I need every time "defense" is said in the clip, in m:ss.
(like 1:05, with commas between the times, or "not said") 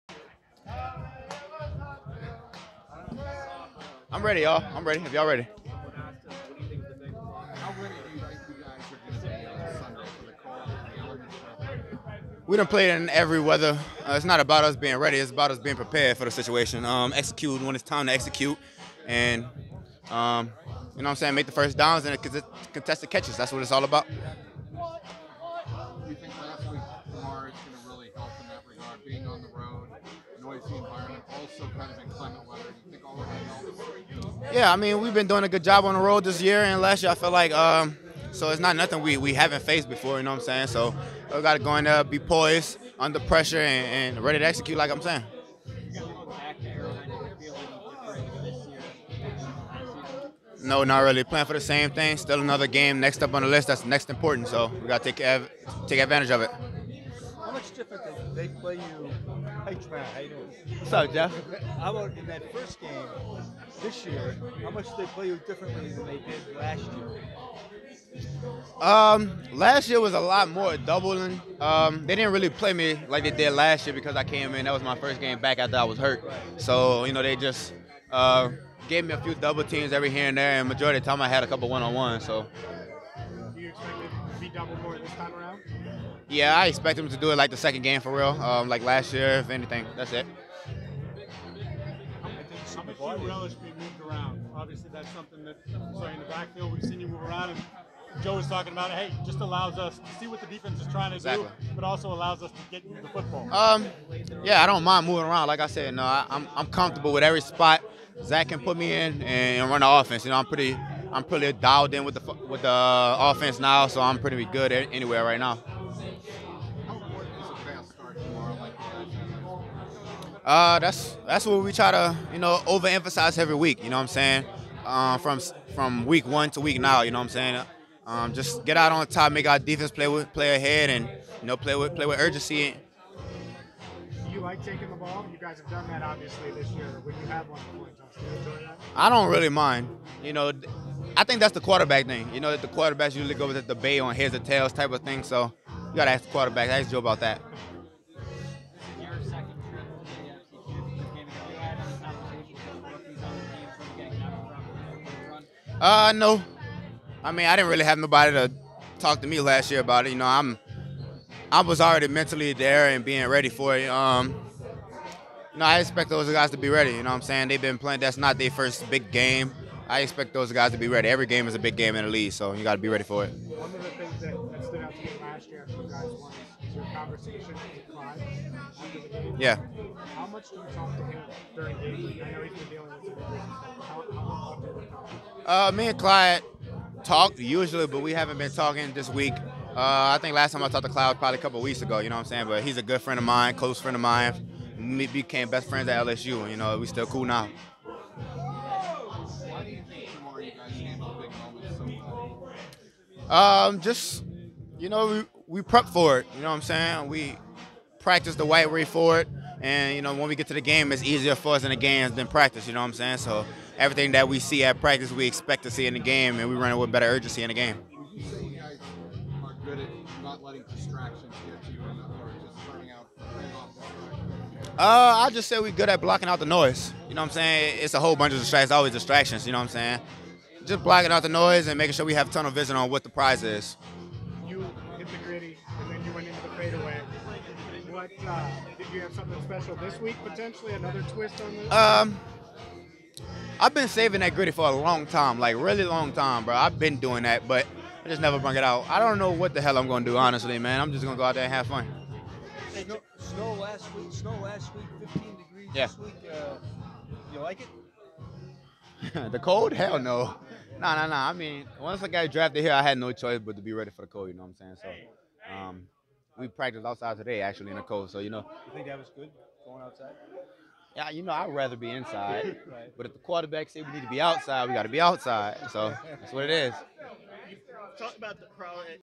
1:40, 2:09.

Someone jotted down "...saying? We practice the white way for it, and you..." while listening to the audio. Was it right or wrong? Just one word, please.
right.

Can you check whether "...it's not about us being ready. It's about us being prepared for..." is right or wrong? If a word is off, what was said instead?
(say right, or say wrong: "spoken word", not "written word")
right.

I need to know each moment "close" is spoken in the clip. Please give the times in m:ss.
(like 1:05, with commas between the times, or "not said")
3:13.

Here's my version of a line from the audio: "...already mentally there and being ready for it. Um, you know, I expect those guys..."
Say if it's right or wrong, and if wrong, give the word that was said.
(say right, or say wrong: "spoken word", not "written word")
right.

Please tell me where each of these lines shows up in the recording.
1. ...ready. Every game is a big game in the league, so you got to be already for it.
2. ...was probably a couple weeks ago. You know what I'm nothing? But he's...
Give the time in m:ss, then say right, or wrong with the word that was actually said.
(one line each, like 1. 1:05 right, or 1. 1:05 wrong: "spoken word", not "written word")
1. 2:50 wrong: "ready", not "already"
2. 3:11 wrong: "saying", not "nothing".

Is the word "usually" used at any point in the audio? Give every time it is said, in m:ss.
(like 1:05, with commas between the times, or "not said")
2:23, 3:07.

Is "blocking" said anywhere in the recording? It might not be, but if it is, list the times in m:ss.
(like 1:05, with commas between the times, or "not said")
3:45, 3:50.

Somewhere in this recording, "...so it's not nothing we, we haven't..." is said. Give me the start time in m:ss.
0:38.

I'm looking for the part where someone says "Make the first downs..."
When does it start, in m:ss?
0:21.